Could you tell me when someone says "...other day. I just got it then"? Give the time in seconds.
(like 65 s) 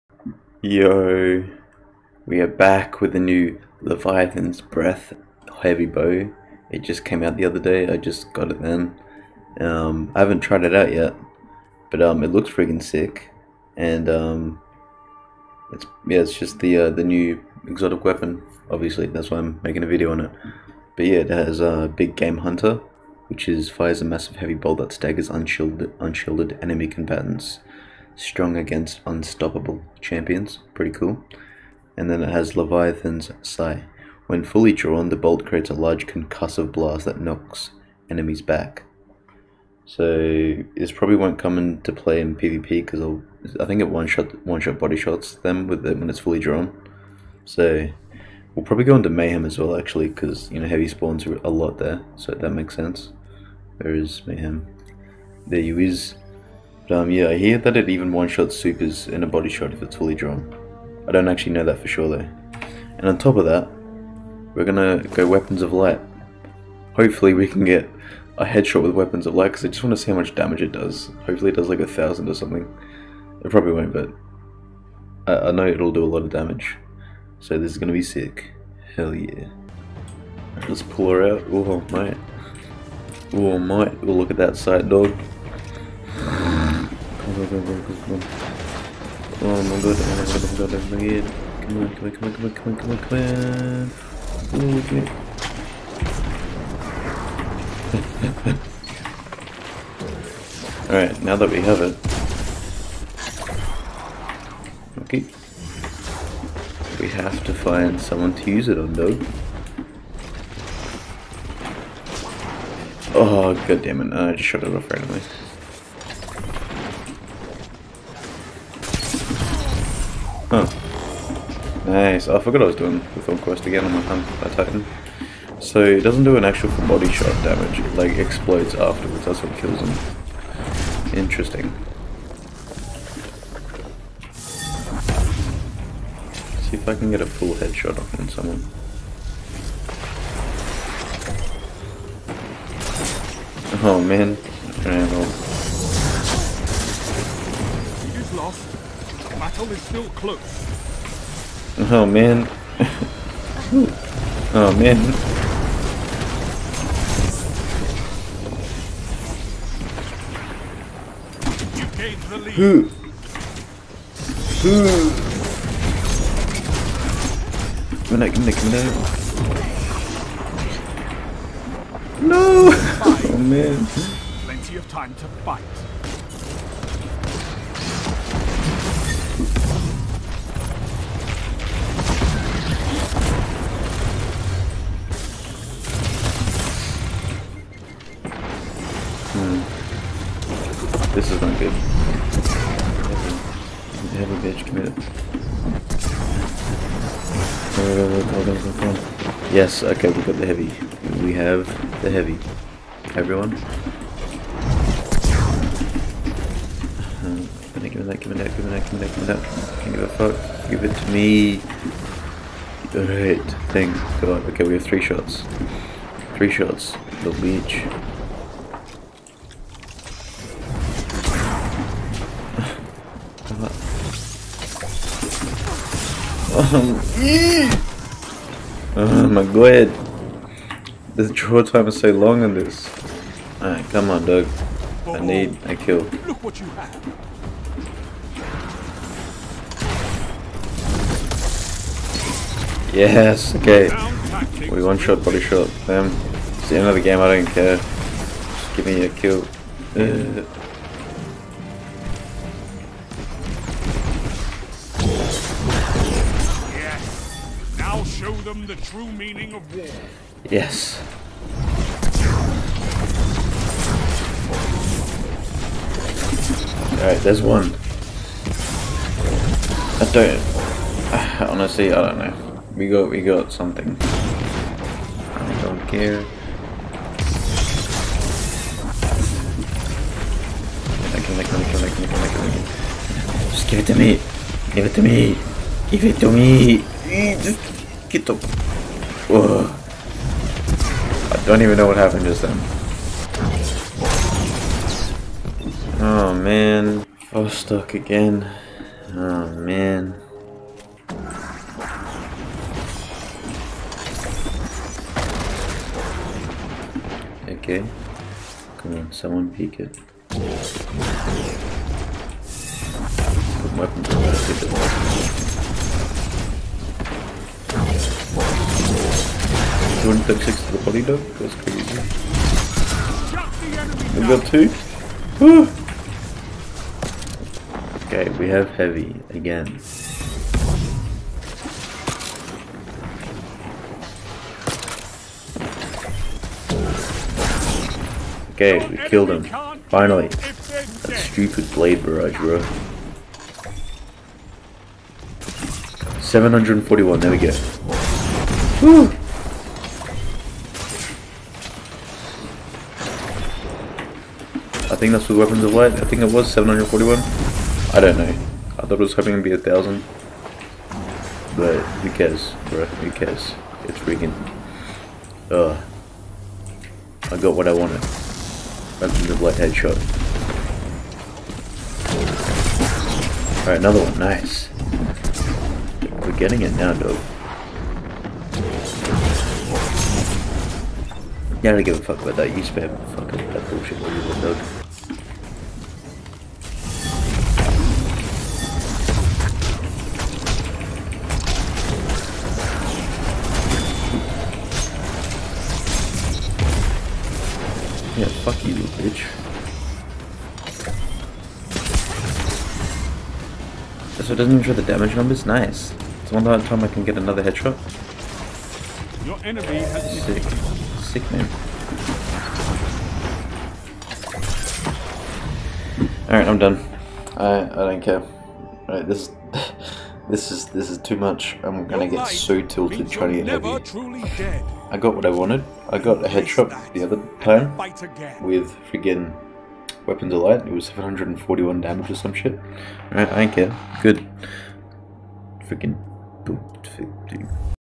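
7 s.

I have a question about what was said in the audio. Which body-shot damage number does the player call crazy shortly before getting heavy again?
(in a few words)
136.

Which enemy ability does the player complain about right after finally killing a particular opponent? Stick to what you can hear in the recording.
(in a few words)
Blade barrage.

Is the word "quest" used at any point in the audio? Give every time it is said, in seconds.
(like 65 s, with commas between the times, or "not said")
123 s.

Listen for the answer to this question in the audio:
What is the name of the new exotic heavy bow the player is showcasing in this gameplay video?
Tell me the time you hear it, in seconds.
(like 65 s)
3 s.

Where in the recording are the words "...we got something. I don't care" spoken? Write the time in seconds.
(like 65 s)
273 s.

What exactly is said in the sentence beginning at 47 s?
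So we'll probably go into mayhem as well actually because you know heavy spawns a lot there, so that makes sense.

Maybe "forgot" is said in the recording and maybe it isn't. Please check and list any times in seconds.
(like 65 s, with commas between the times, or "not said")
122 s.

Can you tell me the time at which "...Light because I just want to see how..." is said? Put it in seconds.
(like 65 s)
69 s.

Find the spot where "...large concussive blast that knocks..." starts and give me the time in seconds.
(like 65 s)
35 s.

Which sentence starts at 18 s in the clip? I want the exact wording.
Obviously, that's why I'm making a video on it.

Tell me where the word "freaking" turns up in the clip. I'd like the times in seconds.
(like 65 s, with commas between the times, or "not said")
363 s.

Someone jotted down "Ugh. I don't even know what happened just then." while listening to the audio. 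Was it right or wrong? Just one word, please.
right.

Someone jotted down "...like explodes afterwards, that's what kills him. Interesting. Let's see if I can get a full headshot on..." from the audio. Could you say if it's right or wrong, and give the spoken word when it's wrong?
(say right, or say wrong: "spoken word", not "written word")
right.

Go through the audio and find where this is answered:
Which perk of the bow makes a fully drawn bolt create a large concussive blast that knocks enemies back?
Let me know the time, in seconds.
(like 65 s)
32 s.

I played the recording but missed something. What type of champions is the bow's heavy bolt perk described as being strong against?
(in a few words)
Unstoppable.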